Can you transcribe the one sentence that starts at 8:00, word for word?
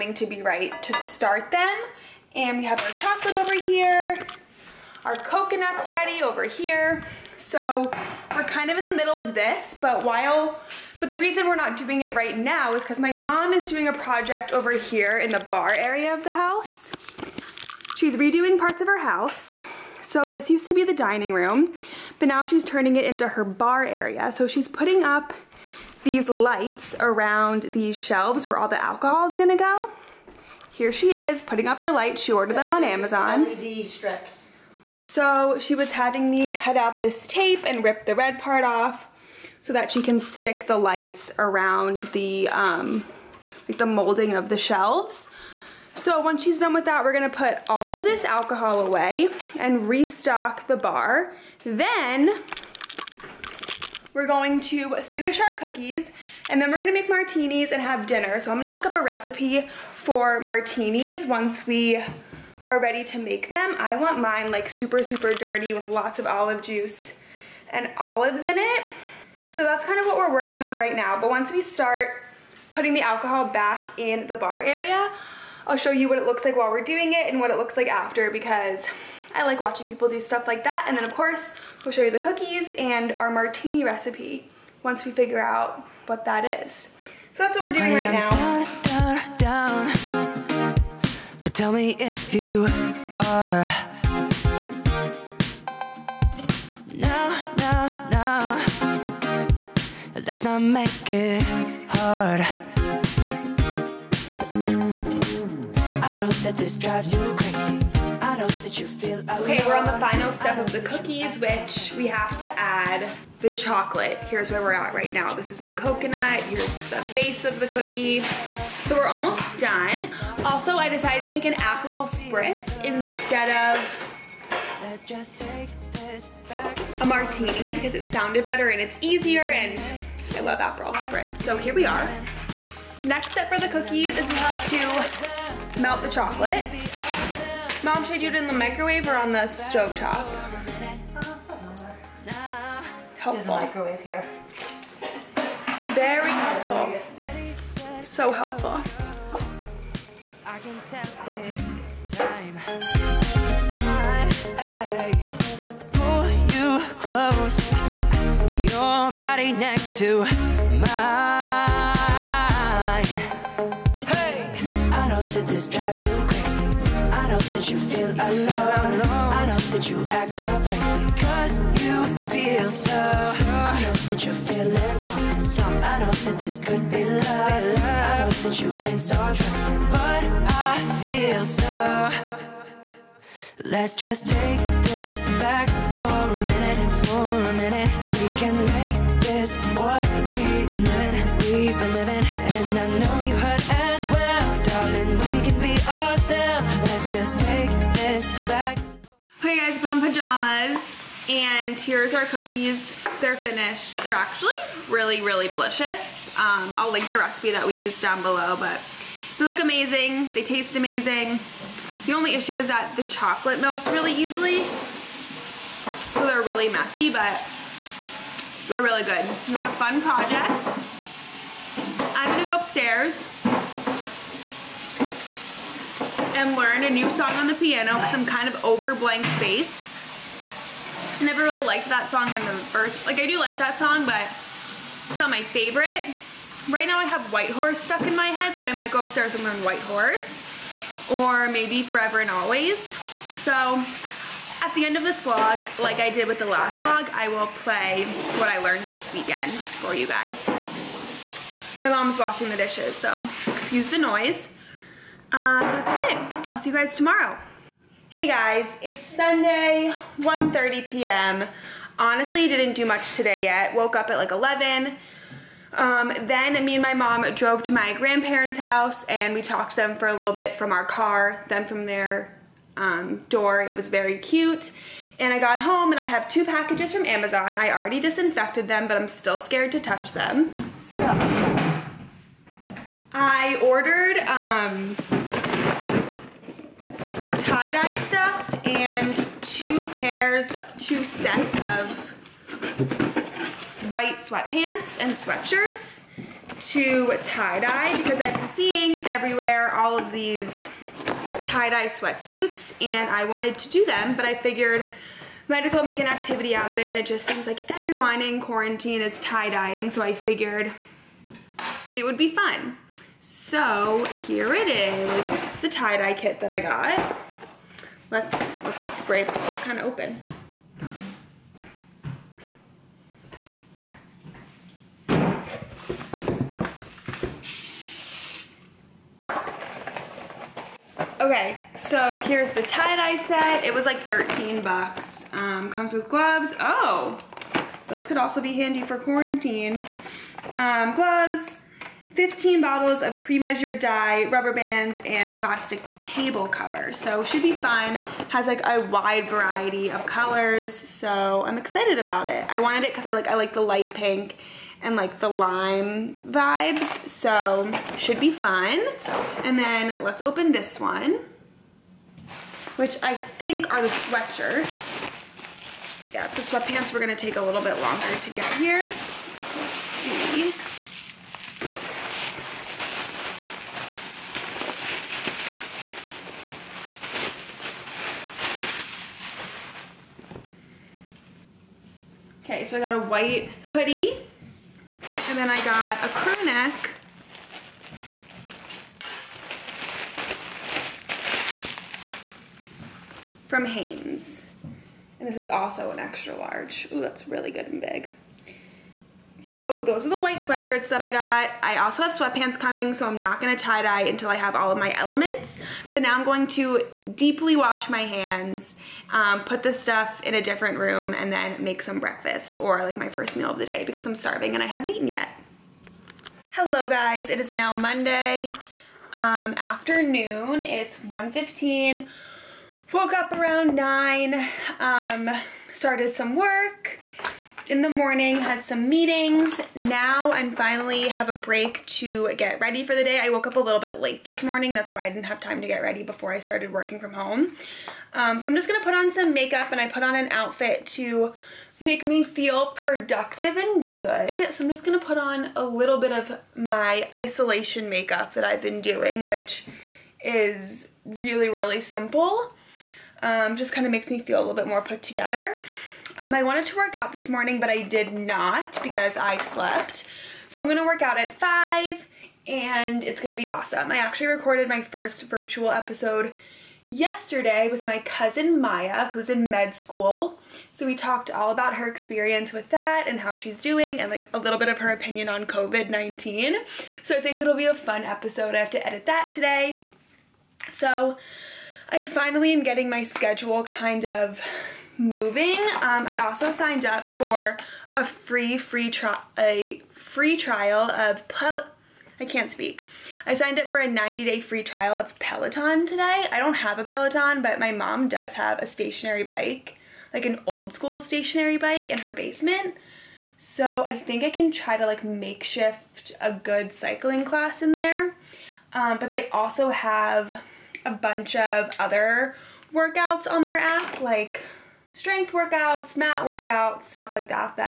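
So I finally am getting my schedule kind of moving.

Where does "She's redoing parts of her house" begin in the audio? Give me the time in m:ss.
0:17.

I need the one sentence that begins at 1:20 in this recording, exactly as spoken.
And then of course, we'll show you the cookies and our martini recipe once we figure out what that is.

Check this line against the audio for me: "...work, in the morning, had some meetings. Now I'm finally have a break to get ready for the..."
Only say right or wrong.
right.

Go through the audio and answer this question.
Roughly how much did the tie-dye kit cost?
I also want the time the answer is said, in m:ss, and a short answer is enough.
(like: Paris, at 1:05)
13 dollars, at 5:34.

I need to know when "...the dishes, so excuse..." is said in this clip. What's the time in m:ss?
4:12.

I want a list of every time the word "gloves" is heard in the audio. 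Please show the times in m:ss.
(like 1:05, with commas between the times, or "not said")
5:36, 5:40.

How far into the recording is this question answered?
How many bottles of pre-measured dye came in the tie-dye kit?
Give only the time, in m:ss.
5:42.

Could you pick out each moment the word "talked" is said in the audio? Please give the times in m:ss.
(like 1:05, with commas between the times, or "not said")
4:29, 7:50.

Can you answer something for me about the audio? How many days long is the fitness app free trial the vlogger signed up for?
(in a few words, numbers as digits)
90.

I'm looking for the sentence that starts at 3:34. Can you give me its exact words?
So they're really messy, but they're really good.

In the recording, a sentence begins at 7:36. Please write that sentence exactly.
Um, I wanted to work out this morning, but I did not because I slept.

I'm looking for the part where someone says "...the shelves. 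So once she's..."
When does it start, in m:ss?
0:44.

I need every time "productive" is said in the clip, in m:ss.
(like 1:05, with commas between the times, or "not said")
7:22.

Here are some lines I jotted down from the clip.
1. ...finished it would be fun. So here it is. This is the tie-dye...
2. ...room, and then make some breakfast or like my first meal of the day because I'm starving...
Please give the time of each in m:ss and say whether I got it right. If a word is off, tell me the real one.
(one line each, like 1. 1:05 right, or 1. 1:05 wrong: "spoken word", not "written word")
1. 5:10 wrong: "figured", not "finished"
2. 6:50 right.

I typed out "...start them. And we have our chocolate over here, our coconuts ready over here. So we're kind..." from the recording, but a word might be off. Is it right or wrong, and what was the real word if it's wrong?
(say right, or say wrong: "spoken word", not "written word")
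right.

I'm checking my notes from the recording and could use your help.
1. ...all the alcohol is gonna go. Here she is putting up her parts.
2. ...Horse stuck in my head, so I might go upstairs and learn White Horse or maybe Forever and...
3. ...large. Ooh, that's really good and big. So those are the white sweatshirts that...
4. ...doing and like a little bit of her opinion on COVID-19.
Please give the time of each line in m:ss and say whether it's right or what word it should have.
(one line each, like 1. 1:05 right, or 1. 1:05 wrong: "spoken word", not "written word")
1. 0:28 wrong: "lights", not "parts"
2. 3:57 right
3. 6:36 right
4. 7:53 right.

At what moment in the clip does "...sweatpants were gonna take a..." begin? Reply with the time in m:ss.
6:06.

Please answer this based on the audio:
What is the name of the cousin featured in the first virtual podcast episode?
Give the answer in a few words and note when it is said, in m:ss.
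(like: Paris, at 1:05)
Maya, at 7:48.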